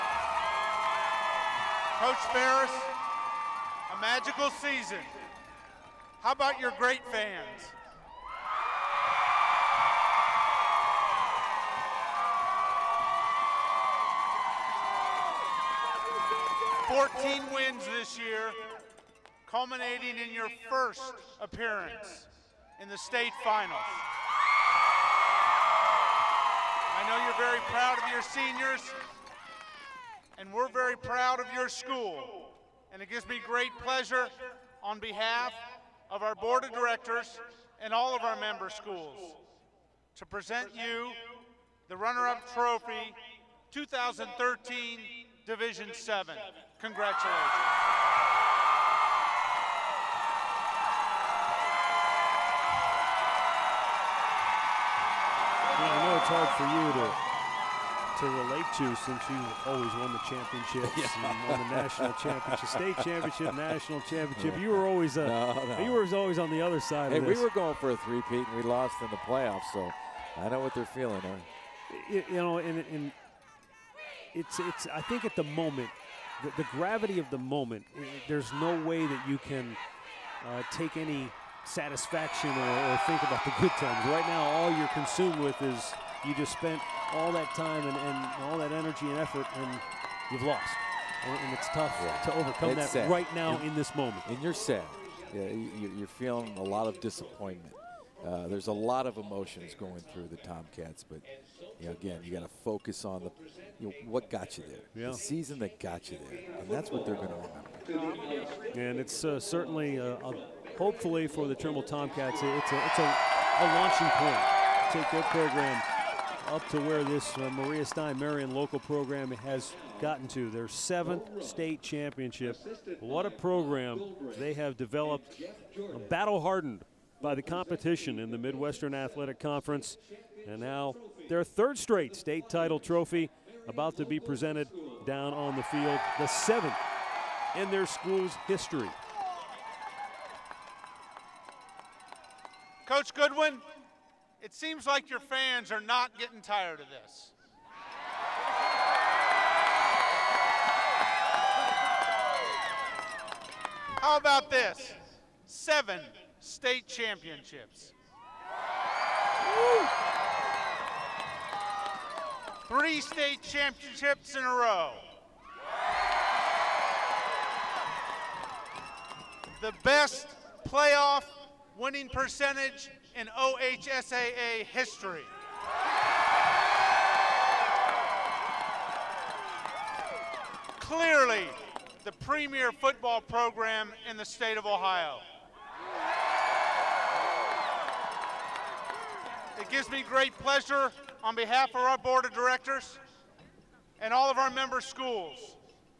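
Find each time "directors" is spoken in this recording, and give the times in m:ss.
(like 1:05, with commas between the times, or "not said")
0:36, 3:12.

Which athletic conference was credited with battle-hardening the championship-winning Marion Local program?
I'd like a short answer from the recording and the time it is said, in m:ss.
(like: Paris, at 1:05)
Midwestern Athletic Conference, at 2:08.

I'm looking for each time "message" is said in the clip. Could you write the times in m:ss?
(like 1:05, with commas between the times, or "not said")
not said.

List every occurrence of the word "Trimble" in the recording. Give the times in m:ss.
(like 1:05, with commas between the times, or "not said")
1:51.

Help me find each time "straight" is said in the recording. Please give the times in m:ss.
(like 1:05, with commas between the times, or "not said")
2:11.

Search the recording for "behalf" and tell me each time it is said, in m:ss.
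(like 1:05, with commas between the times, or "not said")
0:34, 3:11.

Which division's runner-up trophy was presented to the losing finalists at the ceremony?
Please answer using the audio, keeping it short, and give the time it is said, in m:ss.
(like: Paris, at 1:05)
Division 7, at 0:45.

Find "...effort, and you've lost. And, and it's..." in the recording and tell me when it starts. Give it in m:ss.
1:29.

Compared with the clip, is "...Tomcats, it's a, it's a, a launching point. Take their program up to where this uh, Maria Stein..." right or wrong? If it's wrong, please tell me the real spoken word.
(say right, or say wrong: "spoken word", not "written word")
right.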